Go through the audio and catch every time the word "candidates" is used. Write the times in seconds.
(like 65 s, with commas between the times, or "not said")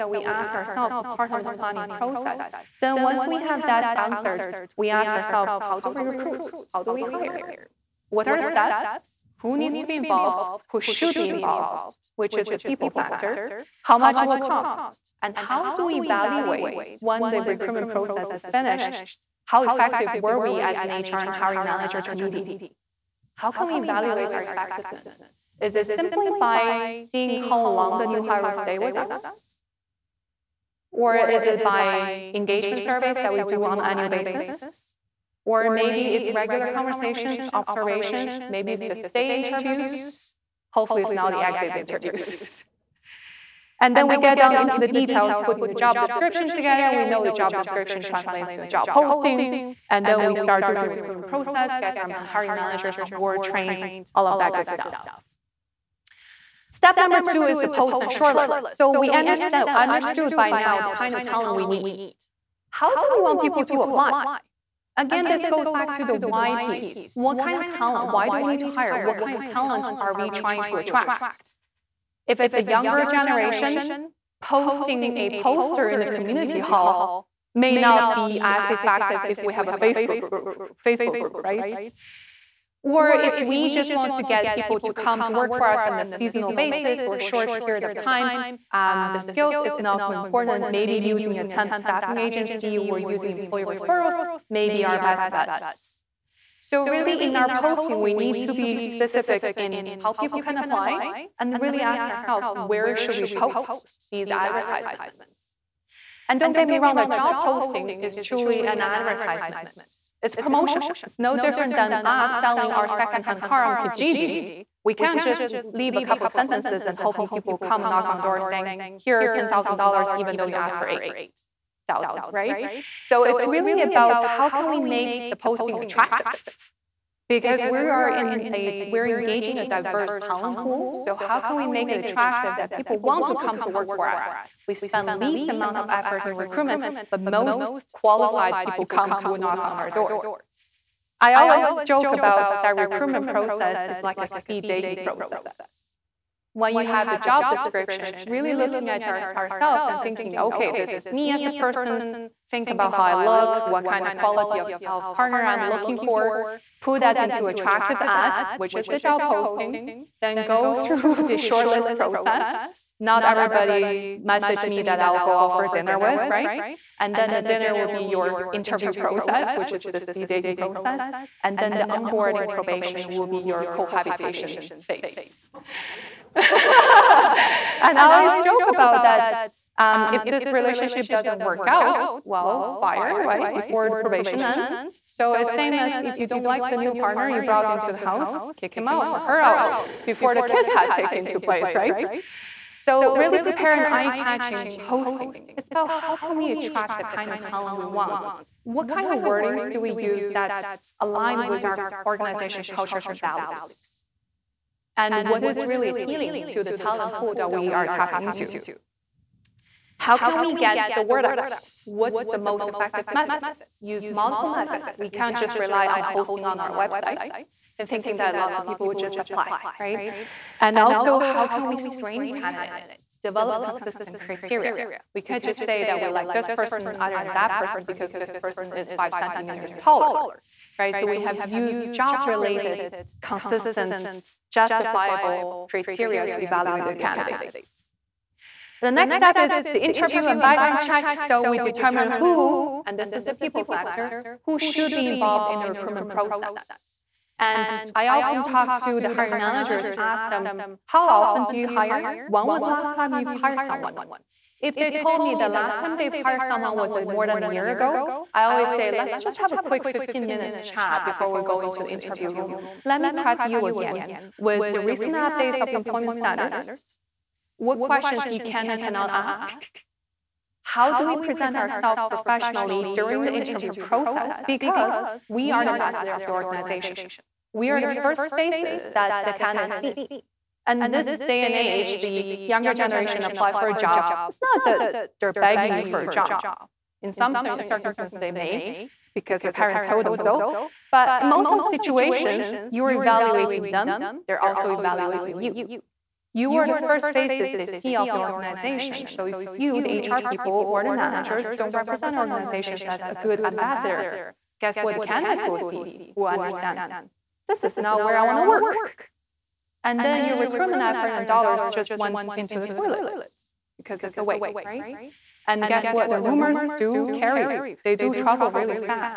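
222 s, 236 s, 279 s, 304 s.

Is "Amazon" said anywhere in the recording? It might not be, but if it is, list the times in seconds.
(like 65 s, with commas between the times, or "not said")
not said.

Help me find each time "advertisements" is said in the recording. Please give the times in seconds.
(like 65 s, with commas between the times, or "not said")
104 s, 108 s.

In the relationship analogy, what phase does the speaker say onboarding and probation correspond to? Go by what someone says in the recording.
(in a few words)
Cohabitation phase.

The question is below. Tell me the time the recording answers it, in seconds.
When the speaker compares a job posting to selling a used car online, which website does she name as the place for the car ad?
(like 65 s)
113 s.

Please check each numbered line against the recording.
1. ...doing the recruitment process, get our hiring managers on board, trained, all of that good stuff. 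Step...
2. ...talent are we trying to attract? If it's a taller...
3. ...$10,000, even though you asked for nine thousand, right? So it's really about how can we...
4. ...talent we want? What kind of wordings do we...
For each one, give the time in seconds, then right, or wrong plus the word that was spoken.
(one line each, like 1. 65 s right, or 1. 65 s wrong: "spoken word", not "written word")
1. 50 s right
2. 69 s wrong: "younger", not "taller"
3. 119 s wrong: "eight", not "nine"
4. 197 s right.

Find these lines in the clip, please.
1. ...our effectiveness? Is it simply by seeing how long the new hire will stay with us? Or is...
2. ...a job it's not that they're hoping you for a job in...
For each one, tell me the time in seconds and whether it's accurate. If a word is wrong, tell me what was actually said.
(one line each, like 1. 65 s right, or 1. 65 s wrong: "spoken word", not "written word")
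1. 24 s right
2. 283 s wrong: "begging", not "hoping".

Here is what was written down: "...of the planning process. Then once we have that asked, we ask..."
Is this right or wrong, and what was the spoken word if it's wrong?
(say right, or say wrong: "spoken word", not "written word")
wrong: "answered", not "asked".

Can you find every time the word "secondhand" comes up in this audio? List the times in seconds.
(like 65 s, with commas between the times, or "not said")
112 s.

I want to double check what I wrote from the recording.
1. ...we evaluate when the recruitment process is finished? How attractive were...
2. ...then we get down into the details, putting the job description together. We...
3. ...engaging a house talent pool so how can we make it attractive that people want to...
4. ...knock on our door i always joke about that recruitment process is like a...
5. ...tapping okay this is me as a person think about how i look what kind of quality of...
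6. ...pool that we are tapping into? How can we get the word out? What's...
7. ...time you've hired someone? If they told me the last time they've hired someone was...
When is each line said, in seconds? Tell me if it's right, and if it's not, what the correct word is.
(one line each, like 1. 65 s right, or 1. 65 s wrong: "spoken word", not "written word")
1. 15 s wrong: "effective", not "attractive"
2. 43 s right
3. 129 s wrong: "diverse", not "house"
4. 139 s right
5. 150 s wrong: "thinking", not "tapping"
6. 207 s right
7. 252 s right.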